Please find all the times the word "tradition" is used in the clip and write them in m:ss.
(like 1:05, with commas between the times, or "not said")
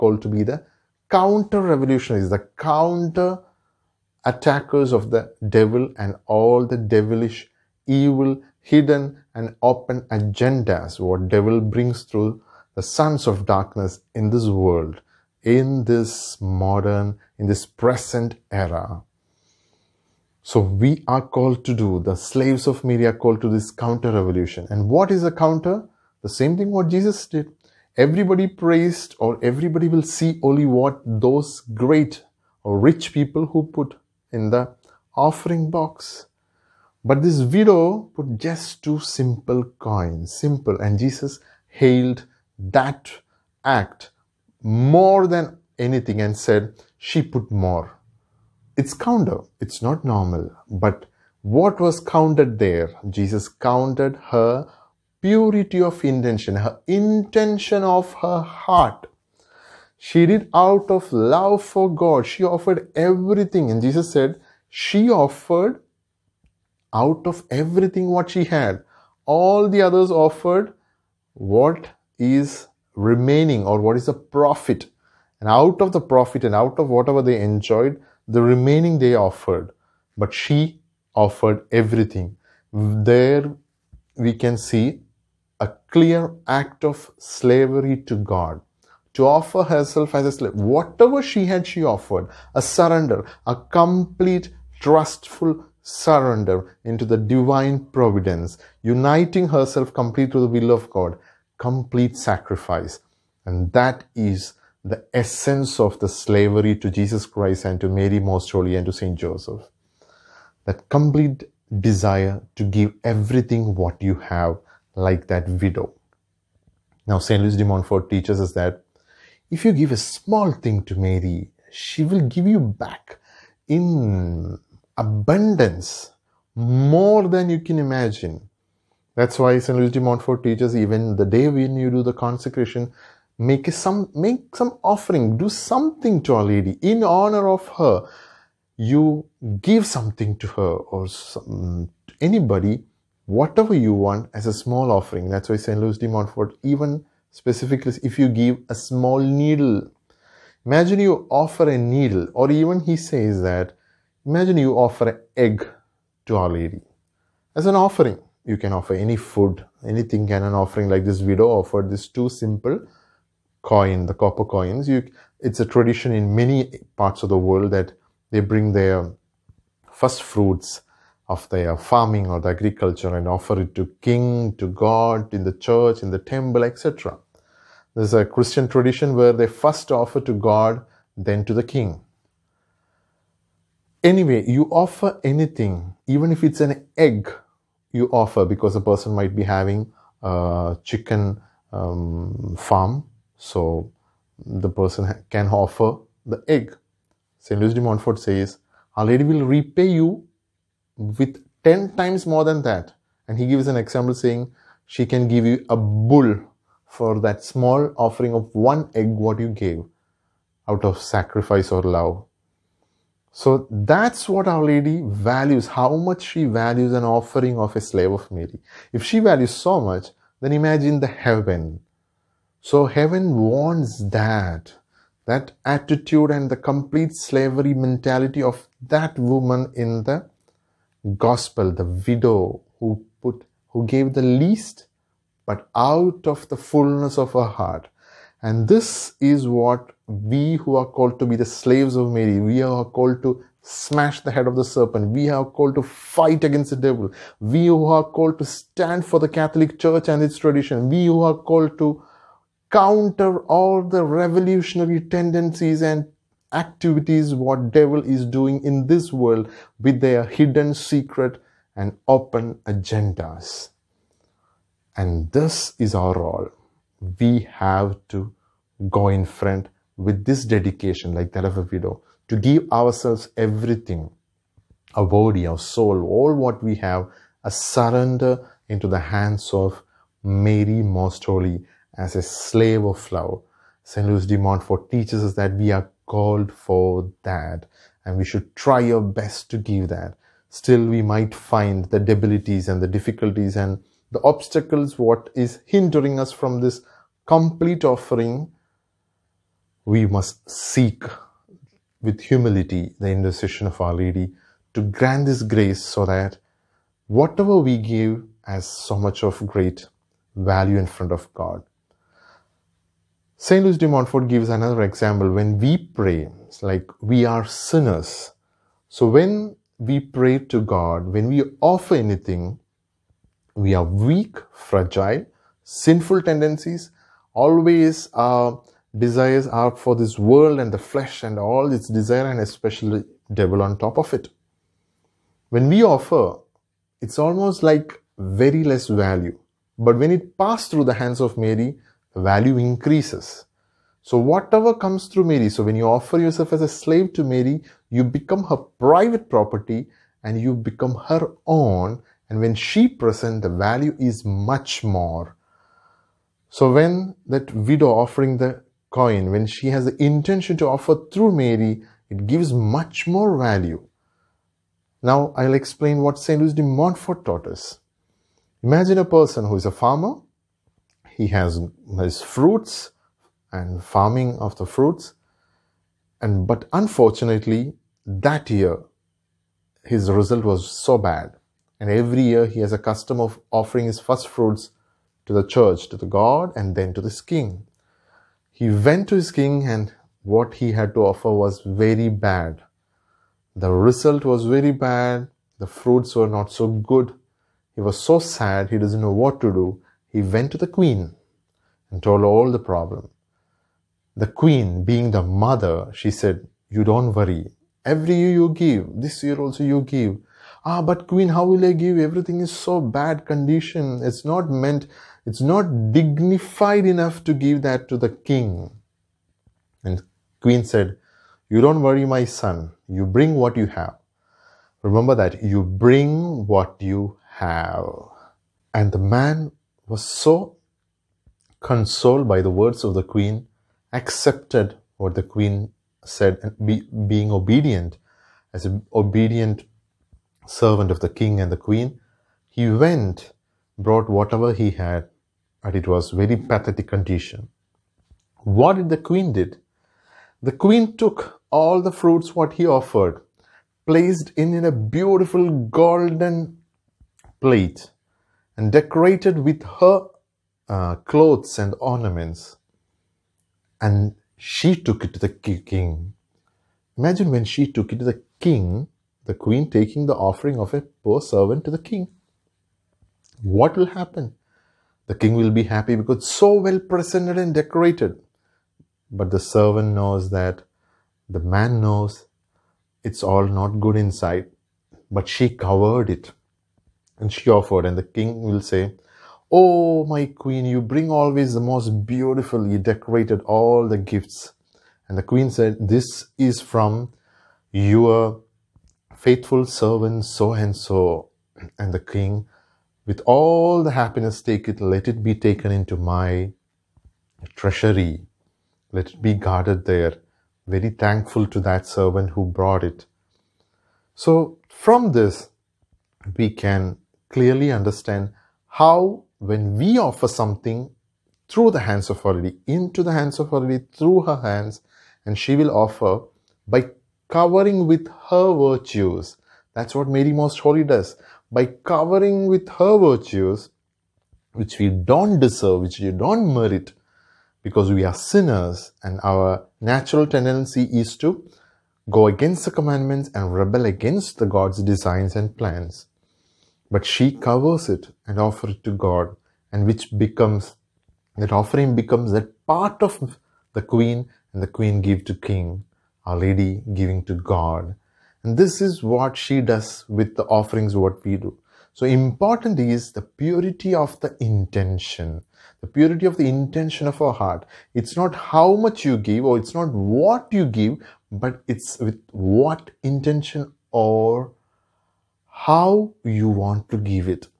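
2:45, 2:58, 4:10.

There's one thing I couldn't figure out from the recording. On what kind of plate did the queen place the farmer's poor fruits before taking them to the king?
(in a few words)
Golden plate.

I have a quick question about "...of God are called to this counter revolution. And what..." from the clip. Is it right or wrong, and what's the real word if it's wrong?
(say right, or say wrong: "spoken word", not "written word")
wrong: "Mary", not "God".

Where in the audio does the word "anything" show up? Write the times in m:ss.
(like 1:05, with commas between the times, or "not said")
0:45, 2:39, 3:05, 5:21.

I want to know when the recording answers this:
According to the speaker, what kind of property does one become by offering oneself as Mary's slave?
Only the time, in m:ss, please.
5:48.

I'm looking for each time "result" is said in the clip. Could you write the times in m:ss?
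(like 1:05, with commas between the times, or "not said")
6:20, 6:33.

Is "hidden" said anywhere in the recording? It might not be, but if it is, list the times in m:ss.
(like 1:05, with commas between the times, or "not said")
0:08, 4:20.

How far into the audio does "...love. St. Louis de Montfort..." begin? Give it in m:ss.
4:43.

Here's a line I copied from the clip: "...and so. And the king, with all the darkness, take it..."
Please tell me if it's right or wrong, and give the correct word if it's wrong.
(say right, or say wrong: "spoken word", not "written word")
wrong: "happiness", not "darkness".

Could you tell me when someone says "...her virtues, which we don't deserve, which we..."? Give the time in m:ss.
8:52.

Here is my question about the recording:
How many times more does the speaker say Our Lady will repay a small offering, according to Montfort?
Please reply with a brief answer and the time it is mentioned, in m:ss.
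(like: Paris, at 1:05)
10, at 3:21.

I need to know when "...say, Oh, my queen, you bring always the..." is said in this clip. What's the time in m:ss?
8:08.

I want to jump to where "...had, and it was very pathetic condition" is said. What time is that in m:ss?
7:24.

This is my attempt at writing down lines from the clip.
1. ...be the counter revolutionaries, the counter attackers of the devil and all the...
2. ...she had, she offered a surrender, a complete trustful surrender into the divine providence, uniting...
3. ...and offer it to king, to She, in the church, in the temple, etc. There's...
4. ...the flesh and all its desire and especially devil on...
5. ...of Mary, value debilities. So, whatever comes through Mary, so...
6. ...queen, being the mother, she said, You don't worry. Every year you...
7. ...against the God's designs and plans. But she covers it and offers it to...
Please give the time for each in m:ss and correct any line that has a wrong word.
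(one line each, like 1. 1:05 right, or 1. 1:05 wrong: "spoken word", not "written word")
1. 0:00 right
2. 1:31 right
3. 2:53 wrong: "God", not "She"
4. 5:30 right
5. 5:41 wrong: "increases", not "debilities"
6. 6:44 right
7. 9:03 right.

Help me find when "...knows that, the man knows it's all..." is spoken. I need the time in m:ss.
7:59.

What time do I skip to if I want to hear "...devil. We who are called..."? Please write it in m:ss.
4:06.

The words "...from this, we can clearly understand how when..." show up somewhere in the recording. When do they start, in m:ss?
8:34.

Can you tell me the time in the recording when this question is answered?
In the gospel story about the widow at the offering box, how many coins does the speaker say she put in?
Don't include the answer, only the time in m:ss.
0:38.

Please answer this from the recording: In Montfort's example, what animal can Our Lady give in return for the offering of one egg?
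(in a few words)
A bull.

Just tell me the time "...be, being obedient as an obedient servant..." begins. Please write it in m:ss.
7:16.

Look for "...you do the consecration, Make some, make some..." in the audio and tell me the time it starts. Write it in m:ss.
2:11.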